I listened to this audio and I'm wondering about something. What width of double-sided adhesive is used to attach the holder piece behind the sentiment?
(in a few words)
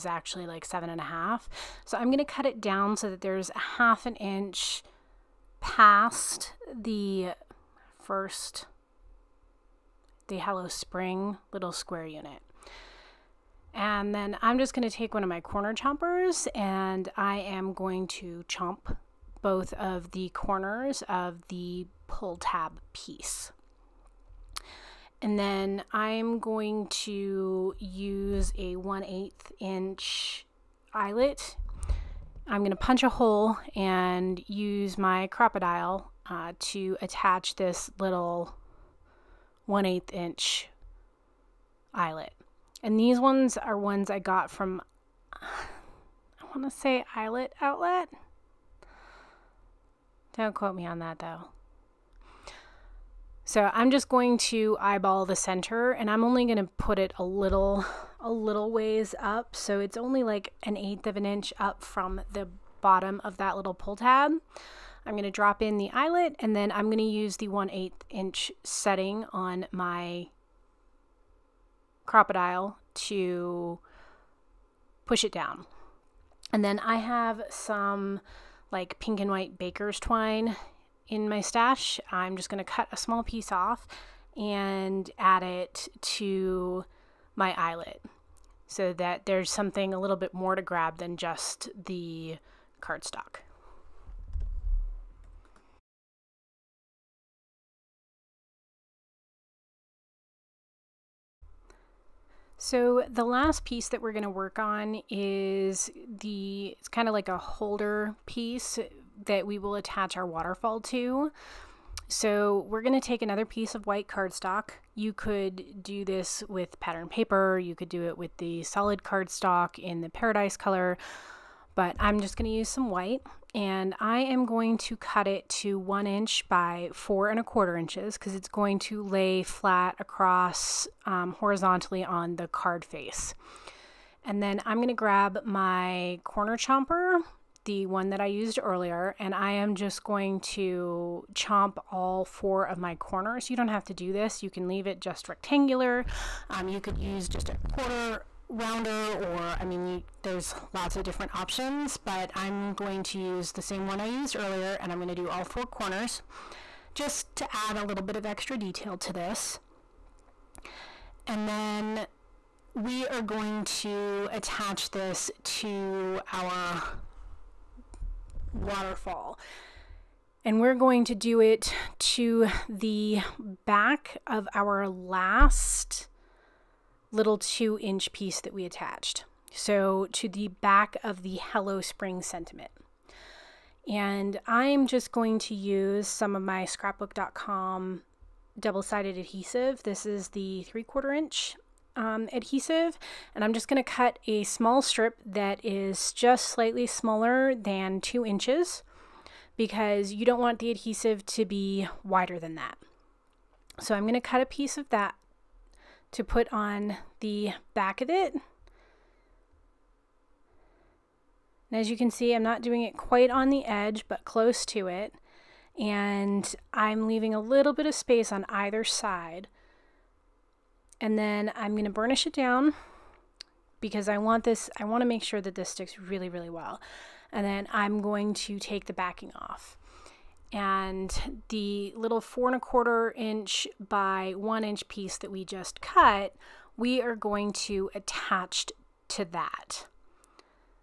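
3/4 inch.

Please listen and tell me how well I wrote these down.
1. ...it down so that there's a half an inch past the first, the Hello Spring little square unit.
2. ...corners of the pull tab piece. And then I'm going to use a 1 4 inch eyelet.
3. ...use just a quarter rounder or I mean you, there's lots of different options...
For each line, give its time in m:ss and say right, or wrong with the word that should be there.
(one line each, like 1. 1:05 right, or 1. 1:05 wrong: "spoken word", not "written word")
1. 0:02 right
2. 0:20 wrong: "8", not "4"
3. 2:26 right.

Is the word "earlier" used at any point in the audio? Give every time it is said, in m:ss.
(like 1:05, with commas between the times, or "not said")
2:18, 2:34.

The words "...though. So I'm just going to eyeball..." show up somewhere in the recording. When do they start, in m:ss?
0:51.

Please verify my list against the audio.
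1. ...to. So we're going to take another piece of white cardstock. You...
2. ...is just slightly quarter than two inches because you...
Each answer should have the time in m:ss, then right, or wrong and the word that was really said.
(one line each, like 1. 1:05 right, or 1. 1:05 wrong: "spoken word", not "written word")
1. 1:50 right
2. 3:15 wrong: "smaller", not "quarter".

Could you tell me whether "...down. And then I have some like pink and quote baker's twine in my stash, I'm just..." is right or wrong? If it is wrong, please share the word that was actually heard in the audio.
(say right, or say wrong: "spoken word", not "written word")
wrong: "white", not "quote".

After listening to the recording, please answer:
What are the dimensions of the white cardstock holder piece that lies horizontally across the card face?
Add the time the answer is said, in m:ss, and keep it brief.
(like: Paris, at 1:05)
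1 by 4 1/4 inches, at 2:05.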